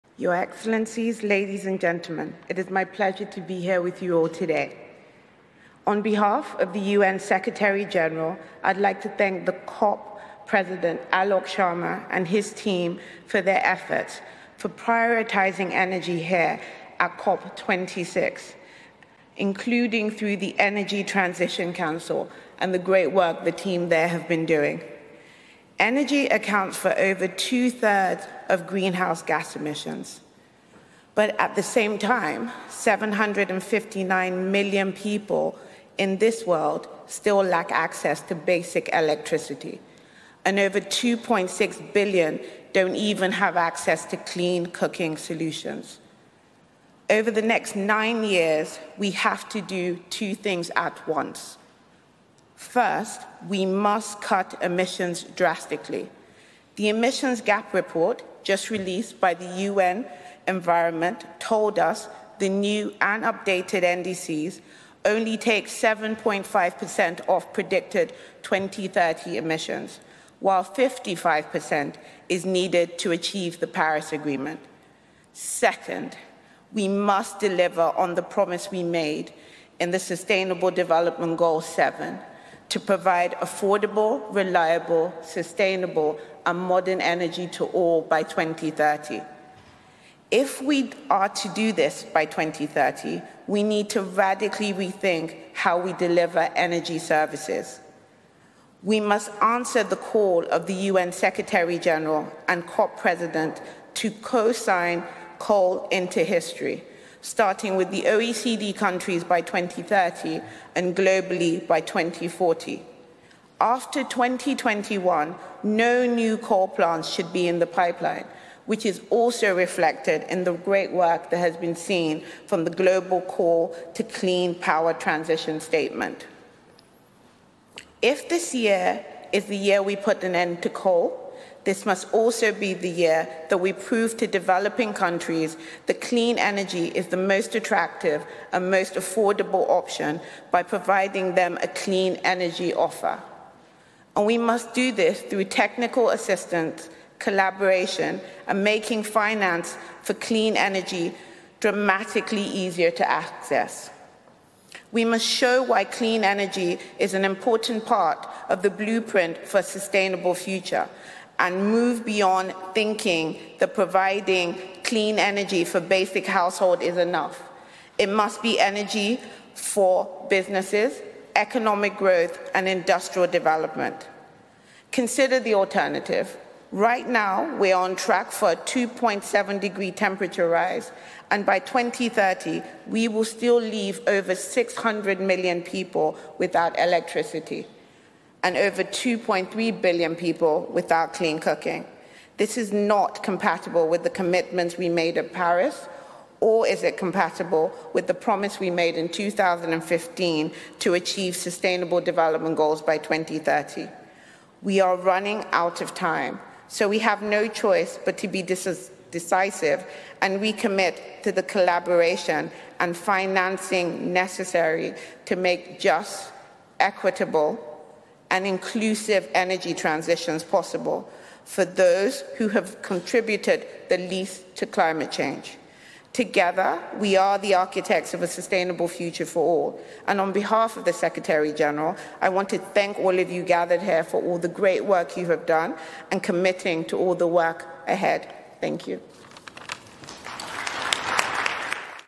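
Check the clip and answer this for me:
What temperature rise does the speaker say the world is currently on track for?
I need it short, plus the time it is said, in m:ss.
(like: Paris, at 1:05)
2.7 degrees, at 2:58.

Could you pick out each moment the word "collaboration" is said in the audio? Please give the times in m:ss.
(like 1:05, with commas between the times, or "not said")
2:27, 3:31.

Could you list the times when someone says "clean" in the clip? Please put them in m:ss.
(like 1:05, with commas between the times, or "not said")
0:44, 2:04, 2:16, 2:21, 2:30, 2:35, 2:44, 3:11.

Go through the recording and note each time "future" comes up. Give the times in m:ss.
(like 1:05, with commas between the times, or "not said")
2:40, 3:48.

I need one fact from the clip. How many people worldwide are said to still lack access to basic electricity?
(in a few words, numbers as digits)
759 million.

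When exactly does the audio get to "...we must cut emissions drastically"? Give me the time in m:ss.
0:53.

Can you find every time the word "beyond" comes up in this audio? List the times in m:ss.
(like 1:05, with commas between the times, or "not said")
2:42.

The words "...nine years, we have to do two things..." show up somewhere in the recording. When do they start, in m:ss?
0:47.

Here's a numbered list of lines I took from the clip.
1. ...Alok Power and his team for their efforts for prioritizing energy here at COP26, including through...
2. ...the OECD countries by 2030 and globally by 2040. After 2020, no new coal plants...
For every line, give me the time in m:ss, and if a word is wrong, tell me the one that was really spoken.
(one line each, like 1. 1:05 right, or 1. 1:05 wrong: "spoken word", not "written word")
1. 0:11 wrong: "Sharma", not "Power"
2. 1:47 wrong: "2021", not "2020".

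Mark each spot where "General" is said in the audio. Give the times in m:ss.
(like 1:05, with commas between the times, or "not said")
0:07, 1:41, 3:51.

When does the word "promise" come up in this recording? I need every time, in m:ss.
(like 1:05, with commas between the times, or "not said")
1:18, 3:18.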